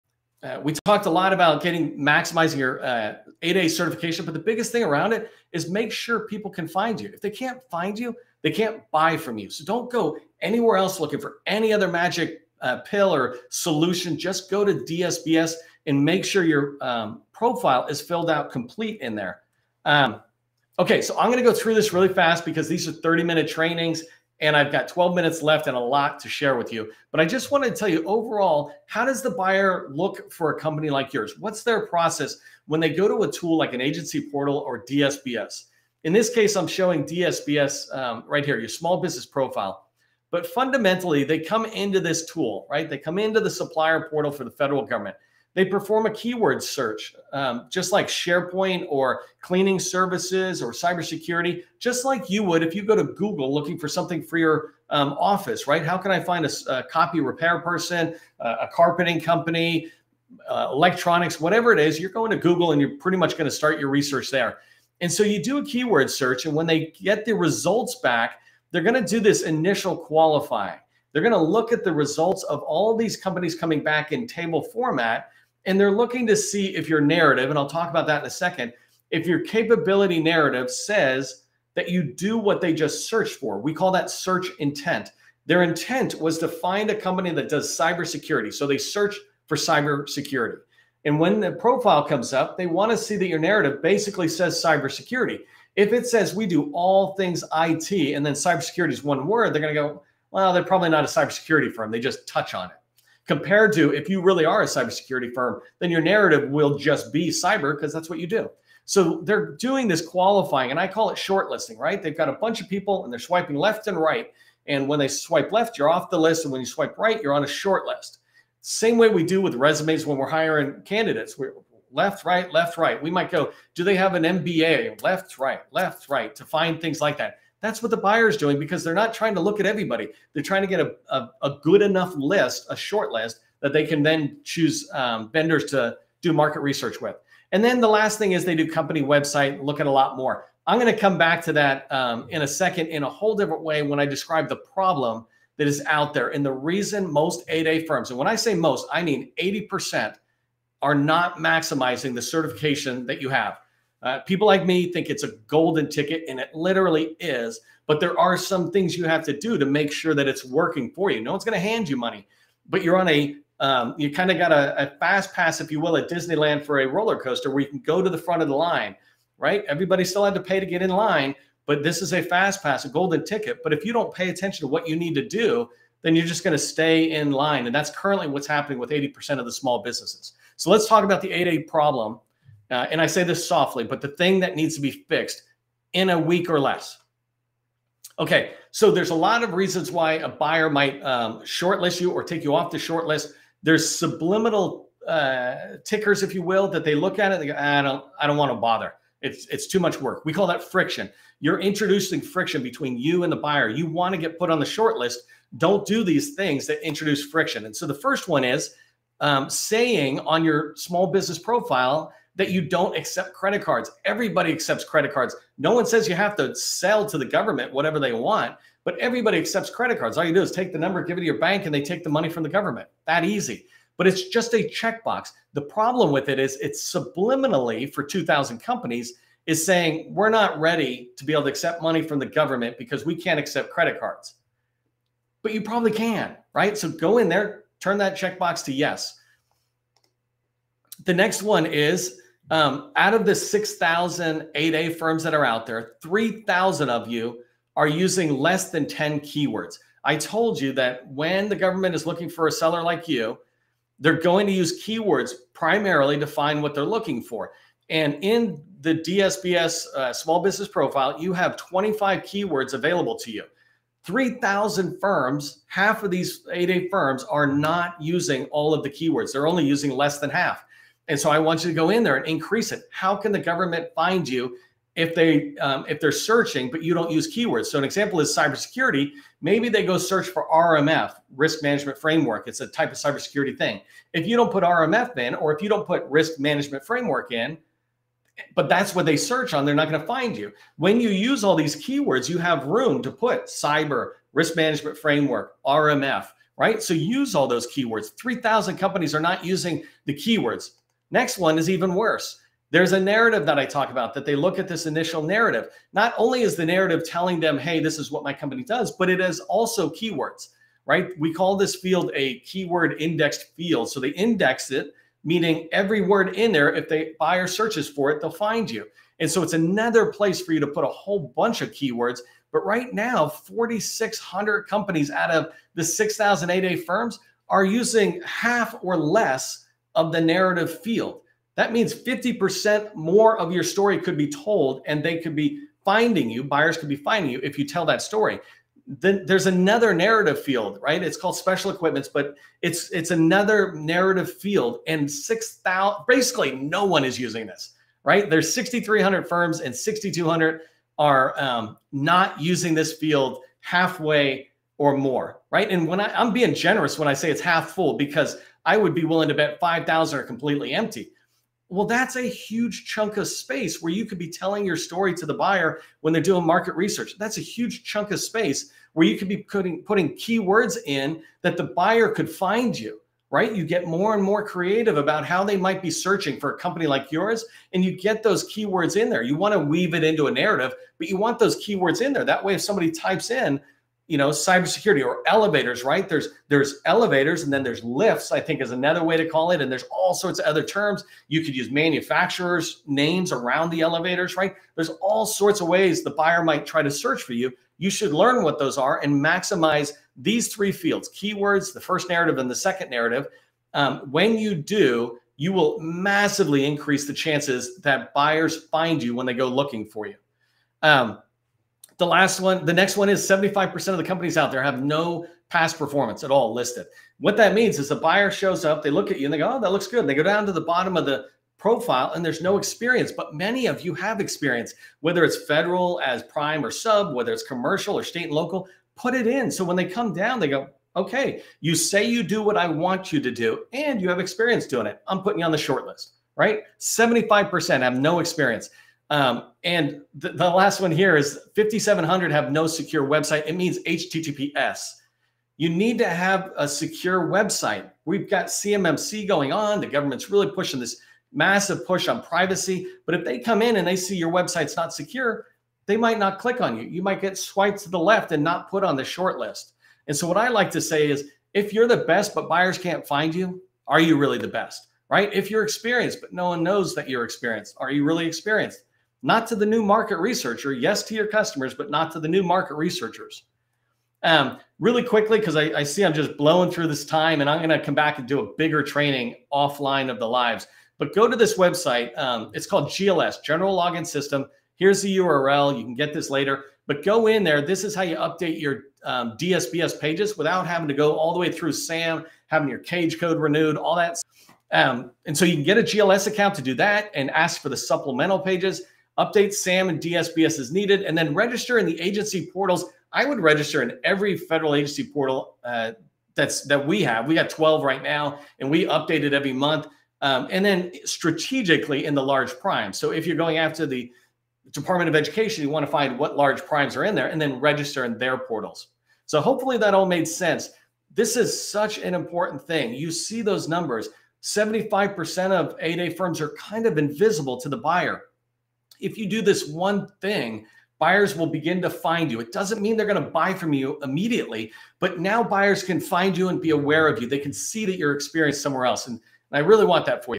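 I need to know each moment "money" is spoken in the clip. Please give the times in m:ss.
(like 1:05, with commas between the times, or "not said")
2:41, 3:42, 3:51.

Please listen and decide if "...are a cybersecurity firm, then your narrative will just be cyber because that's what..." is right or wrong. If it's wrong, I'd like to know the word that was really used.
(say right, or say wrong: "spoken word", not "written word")
right.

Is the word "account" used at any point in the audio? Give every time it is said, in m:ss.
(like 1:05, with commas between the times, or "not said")
8:16.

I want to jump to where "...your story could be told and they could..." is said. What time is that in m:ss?
5:33.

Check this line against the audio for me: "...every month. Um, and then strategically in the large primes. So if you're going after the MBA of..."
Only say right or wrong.
wrong.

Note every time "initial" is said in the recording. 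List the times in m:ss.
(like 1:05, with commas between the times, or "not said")
1:09, 5:04.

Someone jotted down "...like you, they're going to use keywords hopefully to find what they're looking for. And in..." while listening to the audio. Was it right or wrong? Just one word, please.
wrong.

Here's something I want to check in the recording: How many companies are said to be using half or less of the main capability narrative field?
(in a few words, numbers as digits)
4,600.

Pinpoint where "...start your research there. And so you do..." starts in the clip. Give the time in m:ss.
1:03.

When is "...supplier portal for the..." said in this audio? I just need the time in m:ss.
0:43.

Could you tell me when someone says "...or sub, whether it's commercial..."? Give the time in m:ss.
7:06.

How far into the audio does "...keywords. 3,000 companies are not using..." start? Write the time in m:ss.
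4:57.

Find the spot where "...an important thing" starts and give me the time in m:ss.
8:41.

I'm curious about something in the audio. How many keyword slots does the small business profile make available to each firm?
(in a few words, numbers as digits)
25.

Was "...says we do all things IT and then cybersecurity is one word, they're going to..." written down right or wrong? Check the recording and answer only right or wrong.
right.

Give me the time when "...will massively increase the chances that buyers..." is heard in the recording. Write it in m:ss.
6:45.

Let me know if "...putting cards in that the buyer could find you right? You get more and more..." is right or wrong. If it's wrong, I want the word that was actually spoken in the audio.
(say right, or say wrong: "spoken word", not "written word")
wrong: "keywords", not "cards".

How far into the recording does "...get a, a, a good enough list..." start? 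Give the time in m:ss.
2:10.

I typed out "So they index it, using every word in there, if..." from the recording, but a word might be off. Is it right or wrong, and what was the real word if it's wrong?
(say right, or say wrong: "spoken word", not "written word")
wrong: "meaning", not "using".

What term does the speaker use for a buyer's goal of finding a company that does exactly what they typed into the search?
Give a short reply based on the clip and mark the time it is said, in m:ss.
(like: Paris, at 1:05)
search intent, at 1:24.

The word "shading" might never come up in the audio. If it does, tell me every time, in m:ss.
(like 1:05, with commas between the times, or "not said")
not said.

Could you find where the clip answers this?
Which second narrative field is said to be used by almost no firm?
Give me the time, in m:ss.
5:41.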